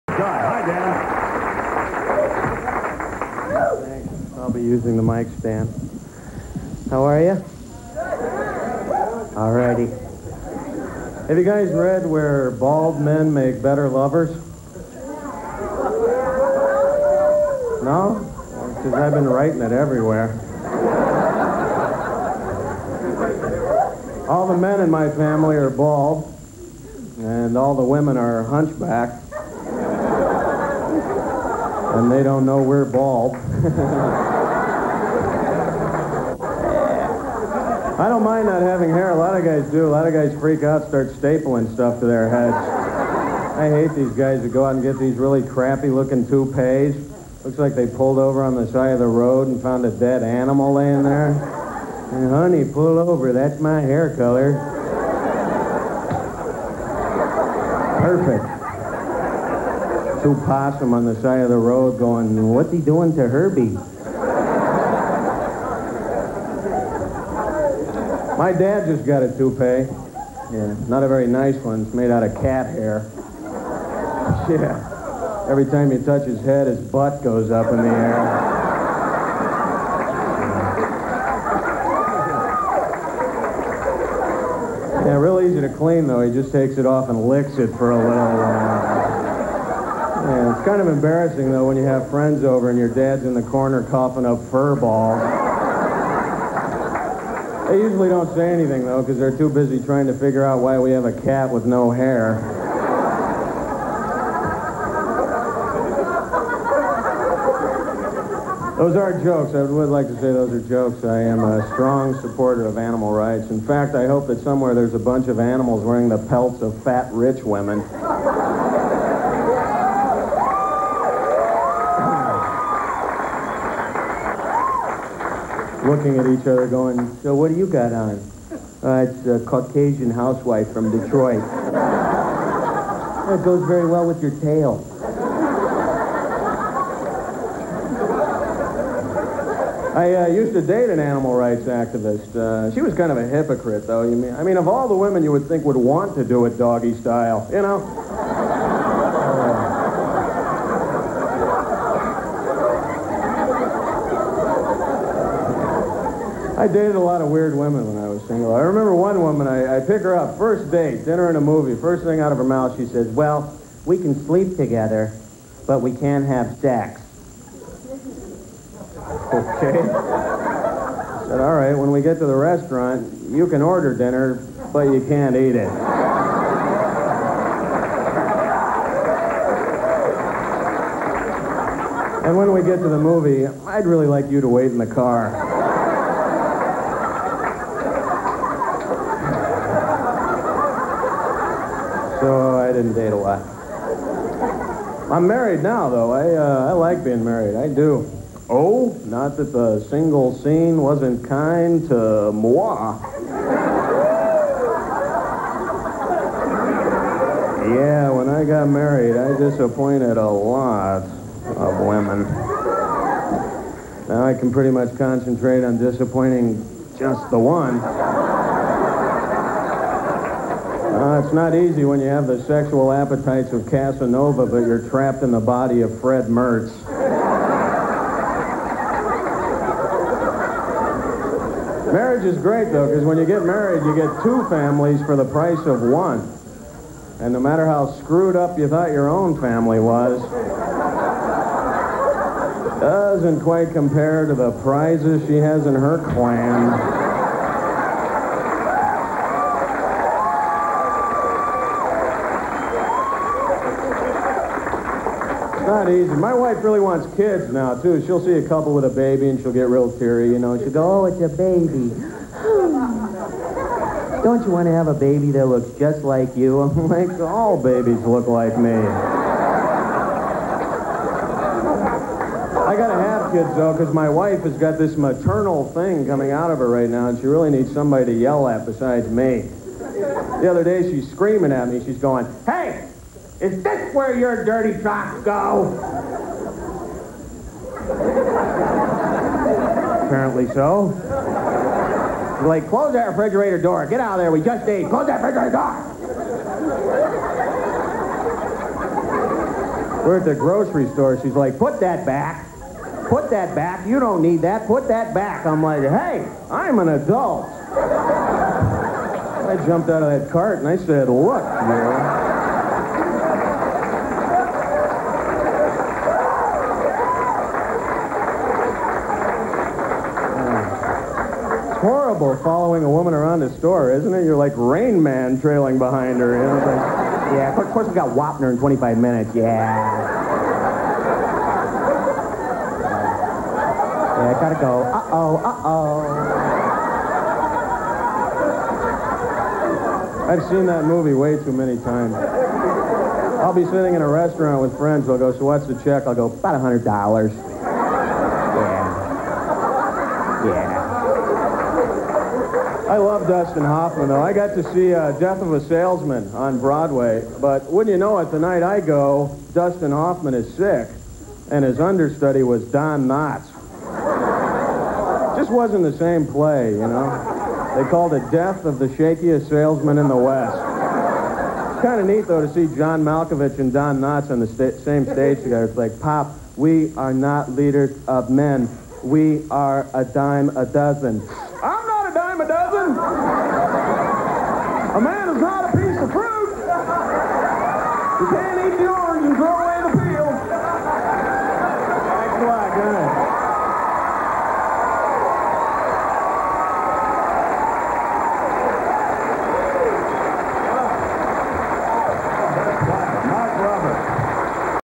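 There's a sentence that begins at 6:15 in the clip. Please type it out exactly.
It's like, Pop, we are not leaders of men.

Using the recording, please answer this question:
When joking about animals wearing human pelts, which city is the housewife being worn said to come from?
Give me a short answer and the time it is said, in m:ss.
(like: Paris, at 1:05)
Detroit, at 2:10.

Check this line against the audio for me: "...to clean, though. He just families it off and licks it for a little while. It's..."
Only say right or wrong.
wrong.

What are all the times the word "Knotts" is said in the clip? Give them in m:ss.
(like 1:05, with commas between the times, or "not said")
6:03, 6:14.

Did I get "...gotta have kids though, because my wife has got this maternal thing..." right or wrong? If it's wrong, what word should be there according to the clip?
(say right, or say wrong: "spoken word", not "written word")
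right.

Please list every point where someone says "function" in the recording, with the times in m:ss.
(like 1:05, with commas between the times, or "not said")
not said.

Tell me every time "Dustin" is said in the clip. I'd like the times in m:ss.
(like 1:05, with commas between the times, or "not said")
5:53, 5:59.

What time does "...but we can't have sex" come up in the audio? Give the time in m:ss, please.
2:45.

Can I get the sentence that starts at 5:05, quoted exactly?
I'm like, hey, I'm an adult.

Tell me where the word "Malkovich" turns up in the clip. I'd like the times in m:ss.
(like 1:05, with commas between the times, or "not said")
6:13.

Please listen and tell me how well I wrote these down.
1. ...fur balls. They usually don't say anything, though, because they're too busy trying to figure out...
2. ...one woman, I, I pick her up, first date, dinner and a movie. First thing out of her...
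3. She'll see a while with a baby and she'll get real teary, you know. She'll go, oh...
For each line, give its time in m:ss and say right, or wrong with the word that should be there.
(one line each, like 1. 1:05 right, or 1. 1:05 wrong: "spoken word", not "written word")
1. 1:34 right
2. 2:38 right
3. 4:18 wrong: "couple", not "while".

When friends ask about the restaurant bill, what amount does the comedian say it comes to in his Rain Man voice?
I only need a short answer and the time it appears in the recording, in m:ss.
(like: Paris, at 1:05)
$100, at 5:46.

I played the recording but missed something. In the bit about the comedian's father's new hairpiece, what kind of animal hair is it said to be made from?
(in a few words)
Cat hair.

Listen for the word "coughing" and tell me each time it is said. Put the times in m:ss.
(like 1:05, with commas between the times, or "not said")
1:33.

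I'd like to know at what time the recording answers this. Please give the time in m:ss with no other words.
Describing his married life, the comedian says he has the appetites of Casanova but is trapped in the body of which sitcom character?
3:45.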